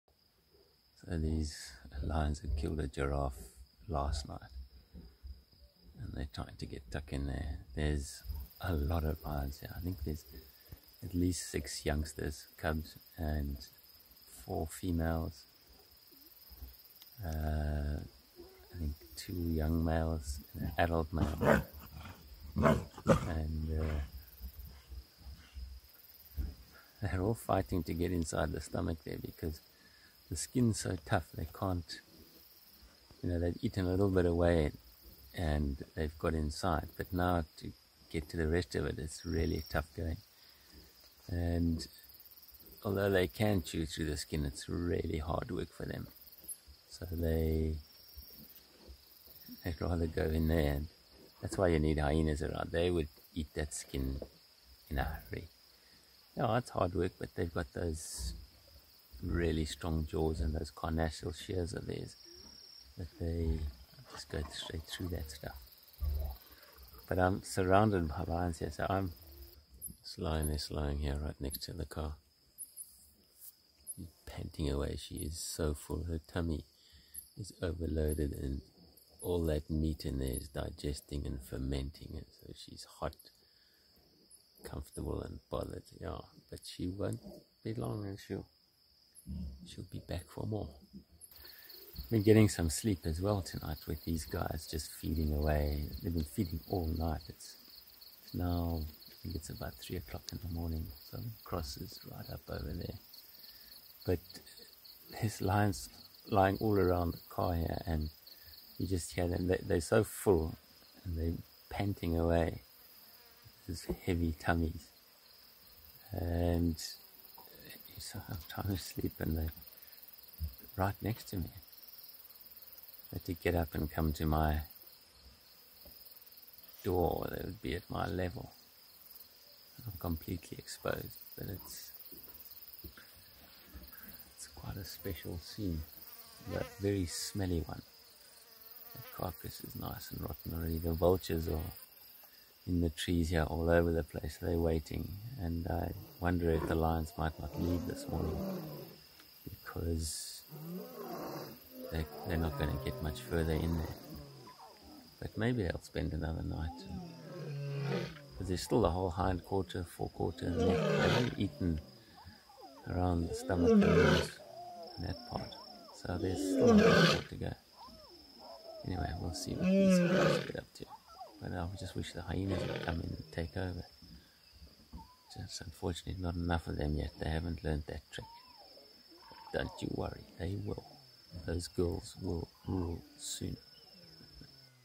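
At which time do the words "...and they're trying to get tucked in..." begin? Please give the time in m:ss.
0:05.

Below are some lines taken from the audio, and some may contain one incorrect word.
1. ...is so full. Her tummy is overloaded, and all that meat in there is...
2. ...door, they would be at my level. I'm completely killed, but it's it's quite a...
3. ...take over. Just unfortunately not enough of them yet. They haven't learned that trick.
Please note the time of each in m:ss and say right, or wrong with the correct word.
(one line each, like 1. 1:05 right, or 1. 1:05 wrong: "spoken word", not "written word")
1. 1:15 right
2. 2:06 wrong: "exposed", not "killed"
3. 2:53 right.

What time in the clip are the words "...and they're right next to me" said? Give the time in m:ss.
1:59.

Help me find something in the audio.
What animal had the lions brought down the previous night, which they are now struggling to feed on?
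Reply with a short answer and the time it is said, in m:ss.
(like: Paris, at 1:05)
giraffe, at 0:02.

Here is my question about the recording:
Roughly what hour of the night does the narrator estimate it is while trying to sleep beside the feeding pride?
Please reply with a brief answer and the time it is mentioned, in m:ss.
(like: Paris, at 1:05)
3 o'clock, at 1:39.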